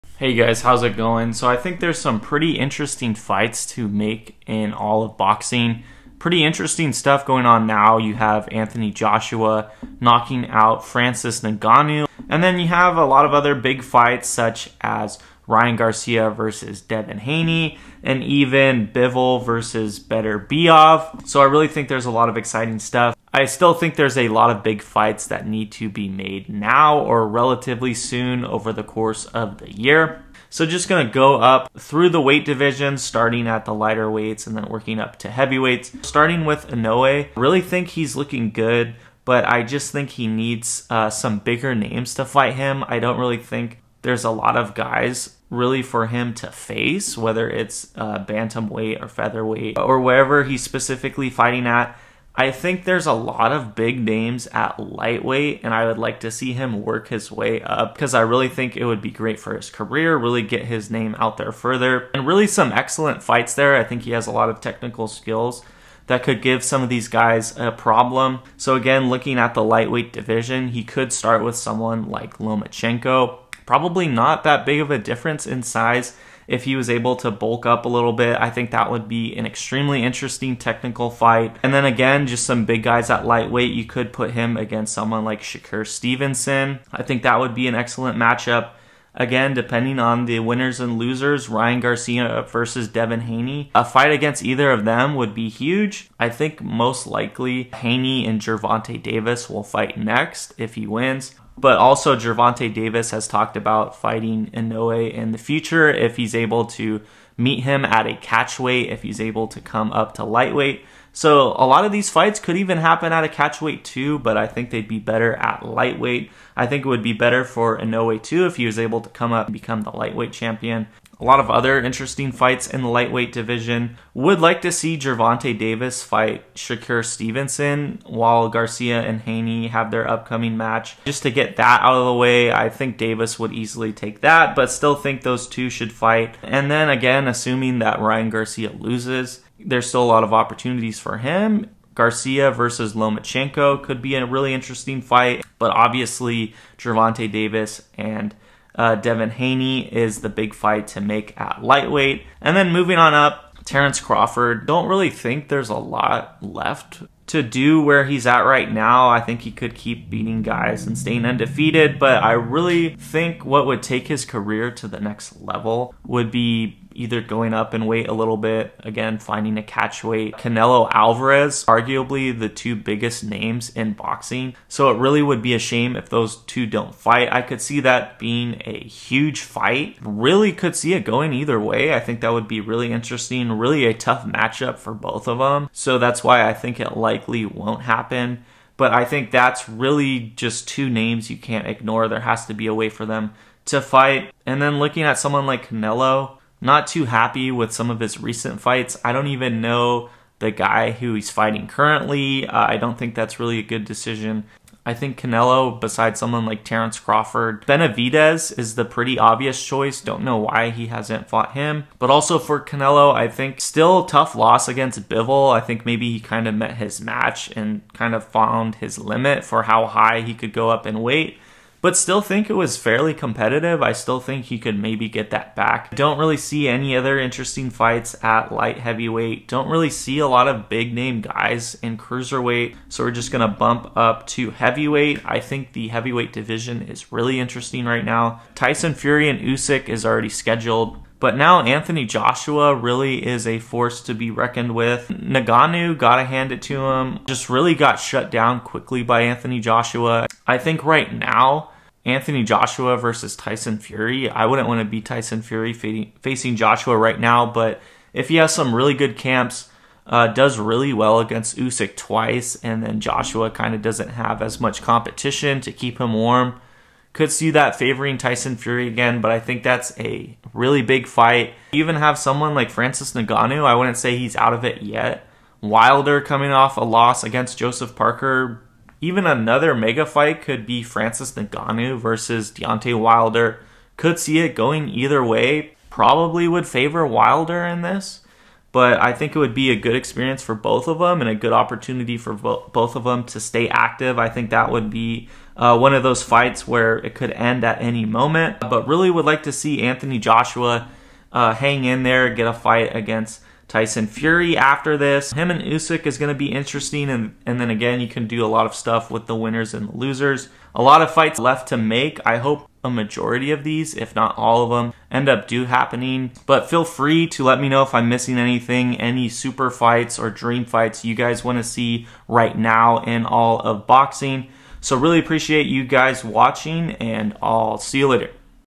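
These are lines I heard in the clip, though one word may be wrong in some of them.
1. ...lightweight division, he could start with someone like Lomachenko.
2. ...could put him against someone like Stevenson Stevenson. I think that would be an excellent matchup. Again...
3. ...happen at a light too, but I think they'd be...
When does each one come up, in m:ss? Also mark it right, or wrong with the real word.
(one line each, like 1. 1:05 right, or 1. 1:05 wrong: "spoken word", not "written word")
1. 1:09 right
2. 1:23 wrong: "Shakur", not "Stevenson"
3. 1:52 wrong: "catchweight", not "light".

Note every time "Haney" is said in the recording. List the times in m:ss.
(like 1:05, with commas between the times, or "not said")
0:17, 1:33, 1:37, 2:09, 2:29.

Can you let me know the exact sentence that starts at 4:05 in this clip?
Ngannou, gotta hand it to him, just really got shut down quickly by Anthony Joshua.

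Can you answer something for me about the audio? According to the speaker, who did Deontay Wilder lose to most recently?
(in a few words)
Joseph Parker.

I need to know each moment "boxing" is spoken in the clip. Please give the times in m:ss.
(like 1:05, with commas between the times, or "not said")
0:05, 2:53, 5:23.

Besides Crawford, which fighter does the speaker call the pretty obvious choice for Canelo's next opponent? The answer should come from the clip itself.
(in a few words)
Benavides.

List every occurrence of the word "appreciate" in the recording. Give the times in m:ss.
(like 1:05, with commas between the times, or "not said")
5:25.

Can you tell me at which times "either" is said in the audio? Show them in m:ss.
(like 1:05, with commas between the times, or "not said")
1:34, 2:46, 3:01, 4:44.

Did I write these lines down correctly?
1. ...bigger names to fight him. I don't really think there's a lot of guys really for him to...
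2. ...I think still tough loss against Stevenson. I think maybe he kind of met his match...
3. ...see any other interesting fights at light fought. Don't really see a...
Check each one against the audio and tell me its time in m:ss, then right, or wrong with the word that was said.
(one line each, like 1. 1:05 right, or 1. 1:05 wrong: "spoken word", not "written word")
1. 0:41 right
2. 3:33 wrong: "Bivol", not "Stevenson"
3. 3:46 wrong: "heavyweight", not "fought".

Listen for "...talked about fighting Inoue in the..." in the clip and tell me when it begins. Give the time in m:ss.
1:43.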